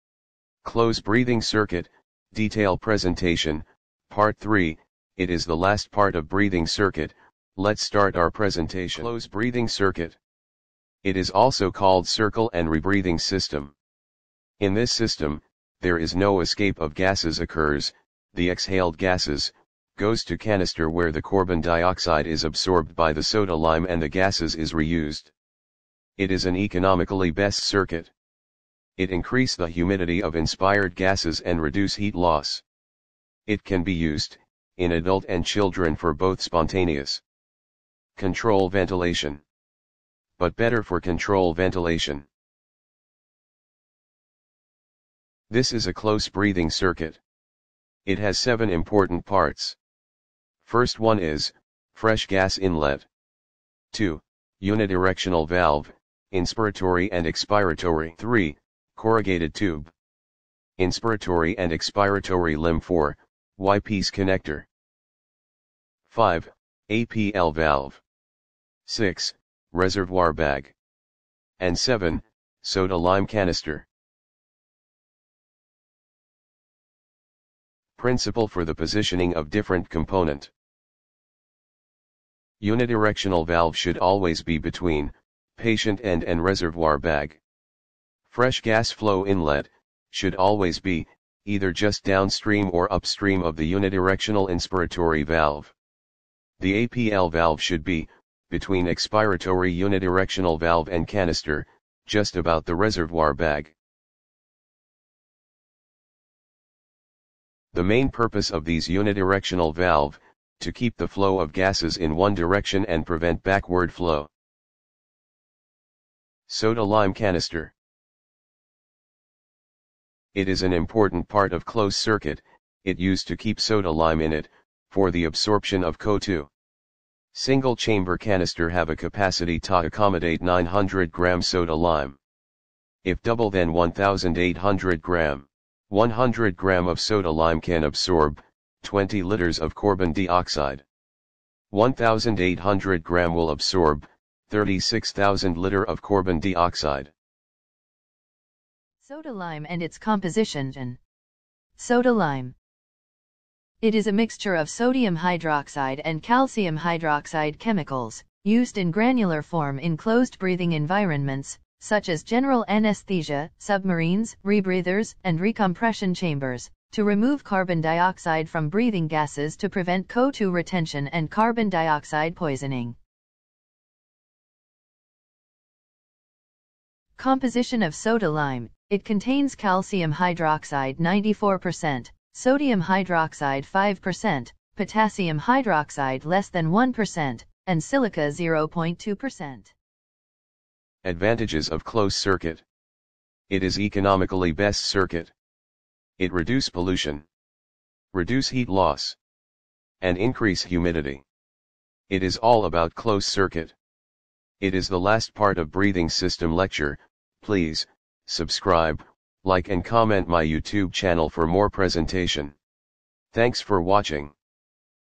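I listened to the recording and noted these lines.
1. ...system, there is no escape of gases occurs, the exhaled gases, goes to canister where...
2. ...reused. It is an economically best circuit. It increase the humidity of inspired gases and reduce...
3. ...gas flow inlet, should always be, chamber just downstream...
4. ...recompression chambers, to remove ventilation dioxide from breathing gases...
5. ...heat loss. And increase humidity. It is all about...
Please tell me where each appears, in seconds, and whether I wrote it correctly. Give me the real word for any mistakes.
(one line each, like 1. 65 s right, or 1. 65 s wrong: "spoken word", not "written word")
1. 14 s right
2. 24 s right
3. 88 s wrong: "either", not "chamber"
4. 165 s wrong: "carbon", not "ventilation"
5. 198 s right.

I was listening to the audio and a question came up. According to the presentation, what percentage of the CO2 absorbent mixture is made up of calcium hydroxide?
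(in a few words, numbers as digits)
94%.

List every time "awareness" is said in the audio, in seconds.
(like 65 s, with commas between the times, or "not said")
not said.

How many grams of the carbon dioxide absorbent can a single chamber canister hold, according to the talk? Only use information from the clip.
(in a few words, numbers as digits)
900 grams.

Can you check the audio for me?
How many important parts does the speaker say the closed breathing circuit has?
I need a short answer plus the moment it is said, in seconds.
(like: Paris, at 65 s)
7, at 48 s.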